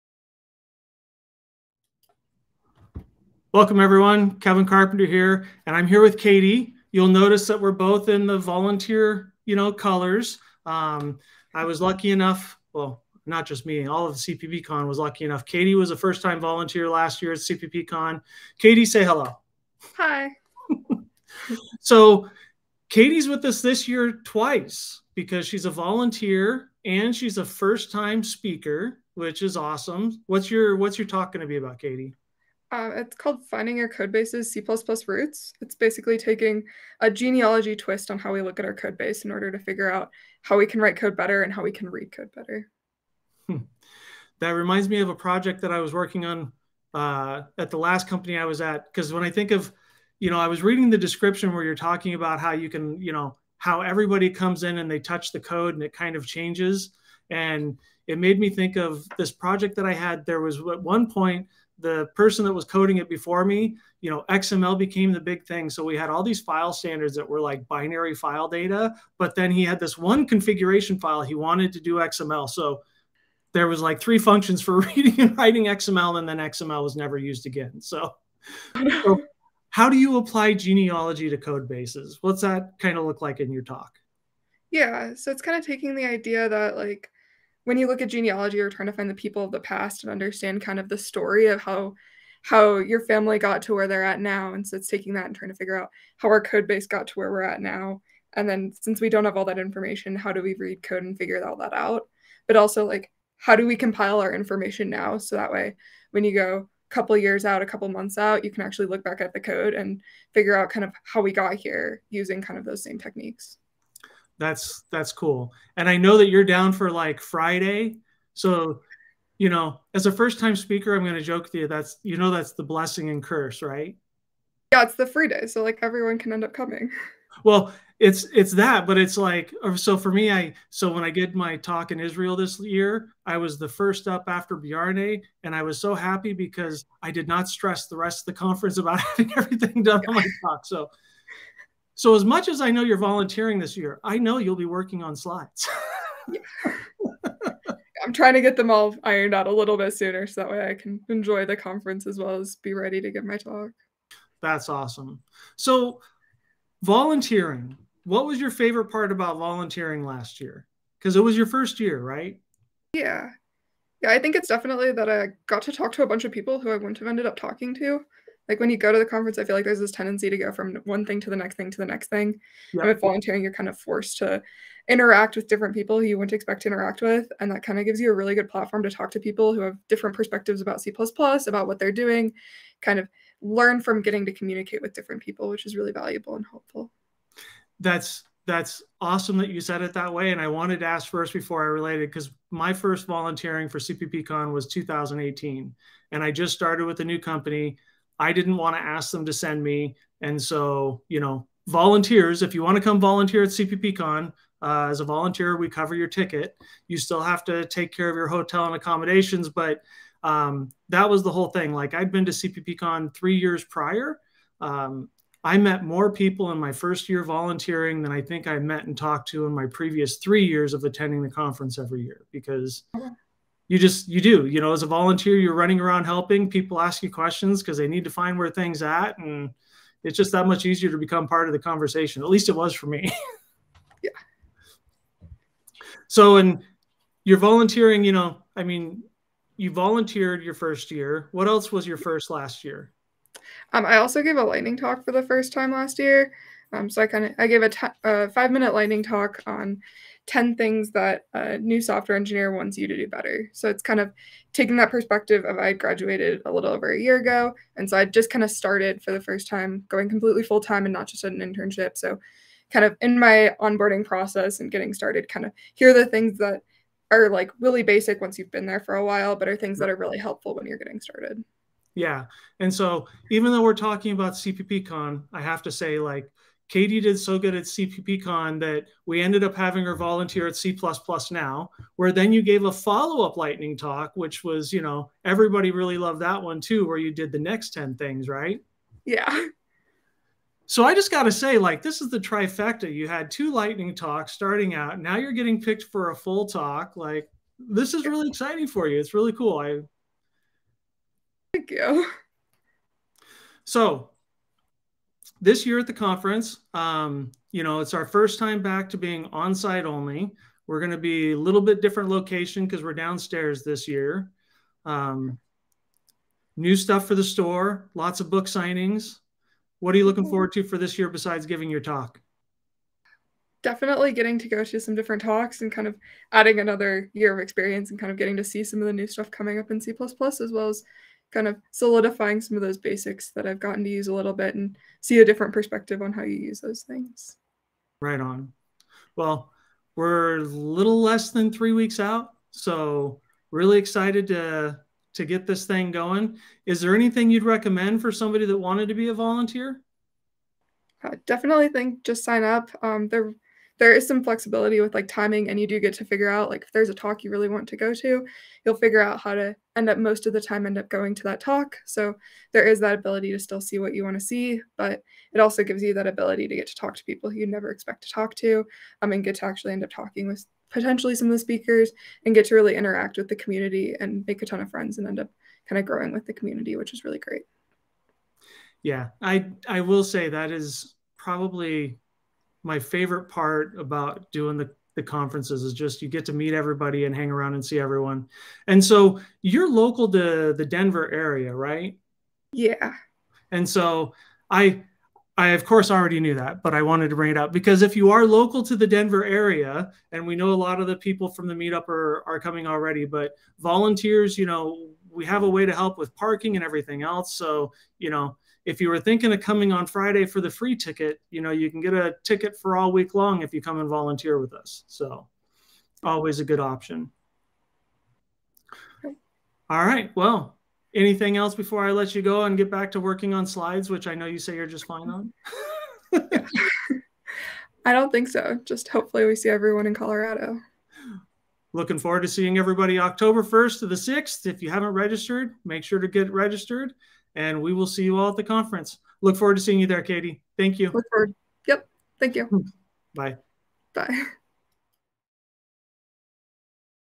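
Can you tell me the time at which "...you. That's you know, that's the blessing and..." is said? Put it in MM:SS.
02:01.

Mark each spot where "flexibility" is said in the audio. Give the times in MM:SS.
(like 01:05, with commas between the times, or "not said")
05:54.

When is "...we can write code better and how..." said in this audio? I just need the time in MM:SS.
00:40.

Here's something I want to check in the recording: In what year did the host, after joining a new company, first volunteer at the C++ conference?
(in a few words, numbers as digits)
2018.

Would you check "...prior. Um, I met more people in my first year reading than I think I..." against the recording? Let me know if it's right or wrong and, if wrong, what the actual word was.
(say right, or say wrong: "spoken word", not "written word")
wrong: "volunteering", not "reading".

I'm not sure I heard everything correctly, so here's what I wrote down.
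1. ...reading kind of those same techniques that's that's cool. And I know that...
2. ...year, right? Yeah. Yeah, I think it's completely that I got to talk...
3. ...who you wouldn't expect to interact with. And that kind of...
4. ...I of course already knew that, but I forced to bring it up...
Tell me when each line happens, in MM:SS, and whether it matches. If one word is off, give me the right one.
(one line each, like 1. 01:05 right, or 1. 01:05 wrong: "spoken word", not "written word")
1. 01:52 wrong: "using", not "reading"
2. 02:41 wrong: "definitely", not "completely"
3. 02:55 right
4. 06:35 wrong: "wanted", not "forced".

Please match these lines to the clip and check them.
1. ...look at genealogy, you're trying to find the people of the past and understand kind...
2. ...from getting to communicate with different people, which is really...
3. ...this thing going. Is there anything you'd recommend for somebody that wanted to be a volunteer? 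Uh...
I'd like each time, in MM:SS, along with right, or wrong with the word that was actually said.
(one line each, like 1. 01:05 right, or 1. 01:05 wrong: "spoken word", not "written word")
1. 01:27 right
2. 03:03 right
3. 05:45 right.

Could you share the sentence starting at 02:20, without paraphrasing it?
So so as much as I know you're volunteering this year, I know you'll be working on slides.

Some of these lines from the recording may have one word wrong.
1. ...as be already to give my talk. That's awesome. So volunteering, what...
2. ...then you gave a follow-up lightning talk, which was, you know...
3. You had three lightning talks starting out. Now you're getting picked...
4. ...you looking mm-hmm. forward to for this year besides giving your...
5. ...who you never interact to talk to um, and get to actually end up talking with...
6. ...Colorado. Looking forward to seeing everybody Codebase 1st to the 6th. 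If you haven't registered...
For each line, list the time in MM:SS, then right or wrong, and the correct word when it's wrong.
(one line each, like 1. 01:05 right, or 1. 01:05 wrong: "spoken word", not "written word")
1. 02:32 wrong: "ready", not "already"
2. 04:42 right
3. 04:52 wrong: "two", not "three"
4. 05:19 right
5. 06:07 wrong: "expect", not "interact"
6. 07:09 wrong: "October", not "Codebase".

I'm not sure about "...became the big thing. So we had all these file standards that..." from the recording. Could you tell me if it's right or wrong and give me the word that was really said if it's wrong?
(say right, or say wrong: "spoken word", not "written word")
right.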